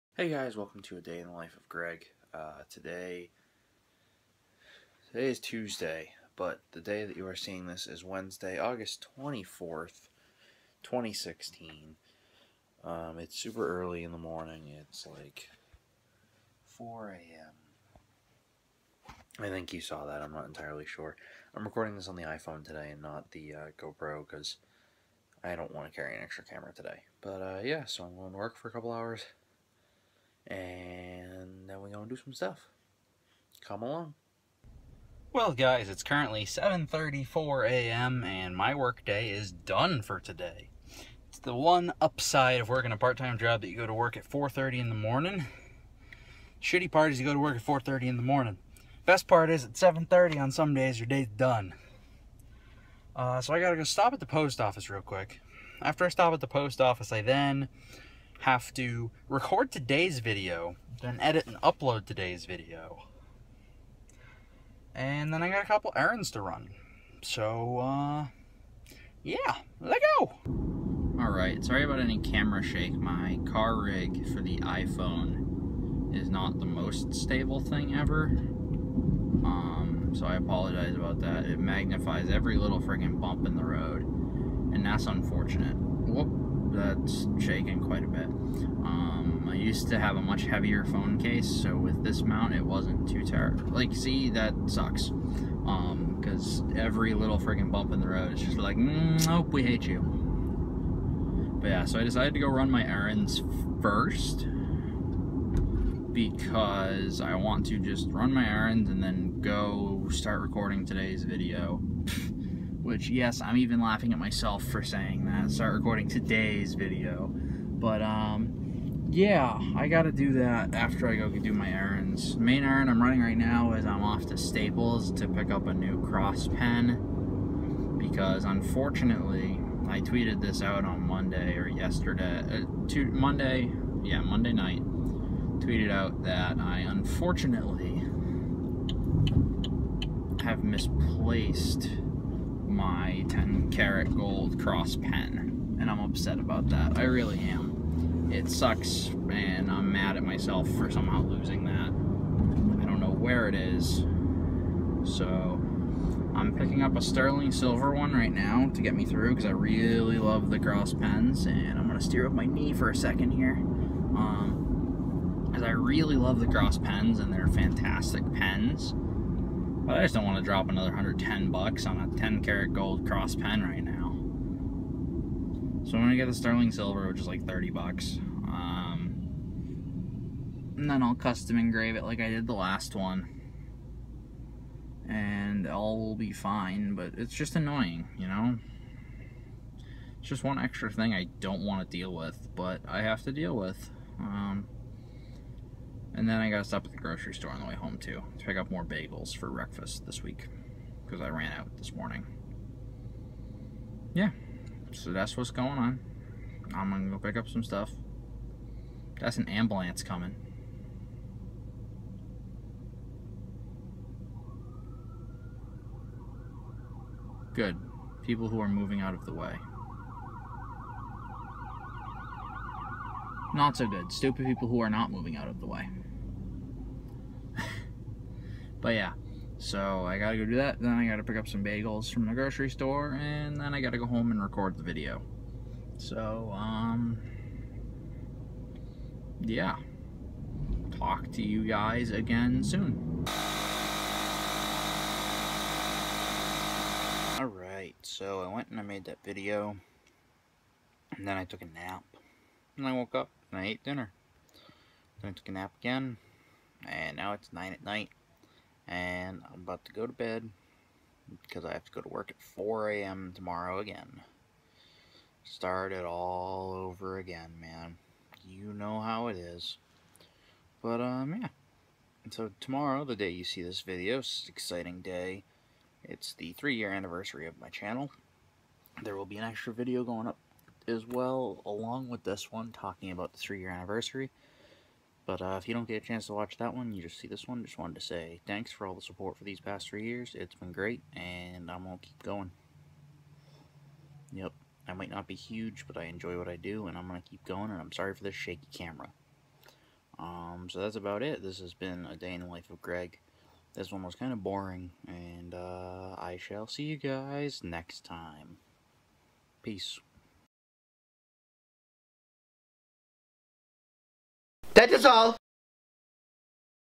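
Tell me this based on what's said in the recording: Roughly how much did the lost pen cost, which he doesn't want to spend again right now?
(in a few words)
110 bucks.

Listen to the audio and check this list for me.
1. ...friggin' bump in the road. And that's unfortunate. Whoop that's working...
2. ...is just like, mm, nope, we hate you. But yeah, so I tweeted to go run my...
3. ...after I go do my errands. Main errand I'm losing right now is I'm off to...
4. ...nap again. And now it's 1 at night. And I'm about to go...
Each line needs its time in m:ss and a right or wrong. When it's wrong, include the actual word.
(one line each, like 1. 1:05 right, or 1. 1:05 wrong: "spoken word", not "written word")
1. 1:22 wrong: "shaking", not "working"
2. 1:38 wrong: "decided", not "tweeted"
3. 2:00 wrong: "running", not "losing"
4. 4:15 wrong: "9", not "1".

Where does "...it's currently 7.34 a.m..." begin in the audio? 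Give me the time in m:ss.
0:35.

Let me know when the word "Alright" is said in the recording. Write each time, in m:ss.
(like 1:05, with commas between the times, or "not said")
1:11, 4:07.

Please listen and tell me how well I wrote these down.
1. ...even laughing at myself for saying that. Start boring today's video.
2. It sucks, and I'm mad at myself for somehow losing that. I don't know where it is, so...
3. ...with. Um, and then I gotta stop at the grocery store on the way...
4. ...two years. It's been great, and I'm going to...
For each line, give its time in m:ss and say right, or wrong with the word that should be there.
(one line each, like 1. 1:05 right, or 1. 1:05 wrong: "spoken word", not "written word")
1. 1:53 wrong: "recording", not "boring"
2. 2:28 right
3. 3:13 right
4. 4:49 wrong: "three", not "two".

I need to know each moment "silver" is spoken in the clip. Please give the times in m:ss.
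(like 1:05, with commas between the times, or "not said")
2:37, 2:56.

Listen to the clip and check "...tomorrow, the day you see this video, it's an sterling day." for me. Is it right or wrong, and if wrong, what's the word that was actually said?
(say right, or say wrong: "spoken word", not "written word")
wrong: "exciting", not "sterling".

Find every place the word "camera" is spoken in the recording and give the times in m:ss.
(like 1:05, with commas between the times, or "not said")
0:26, 1:12, 4:58.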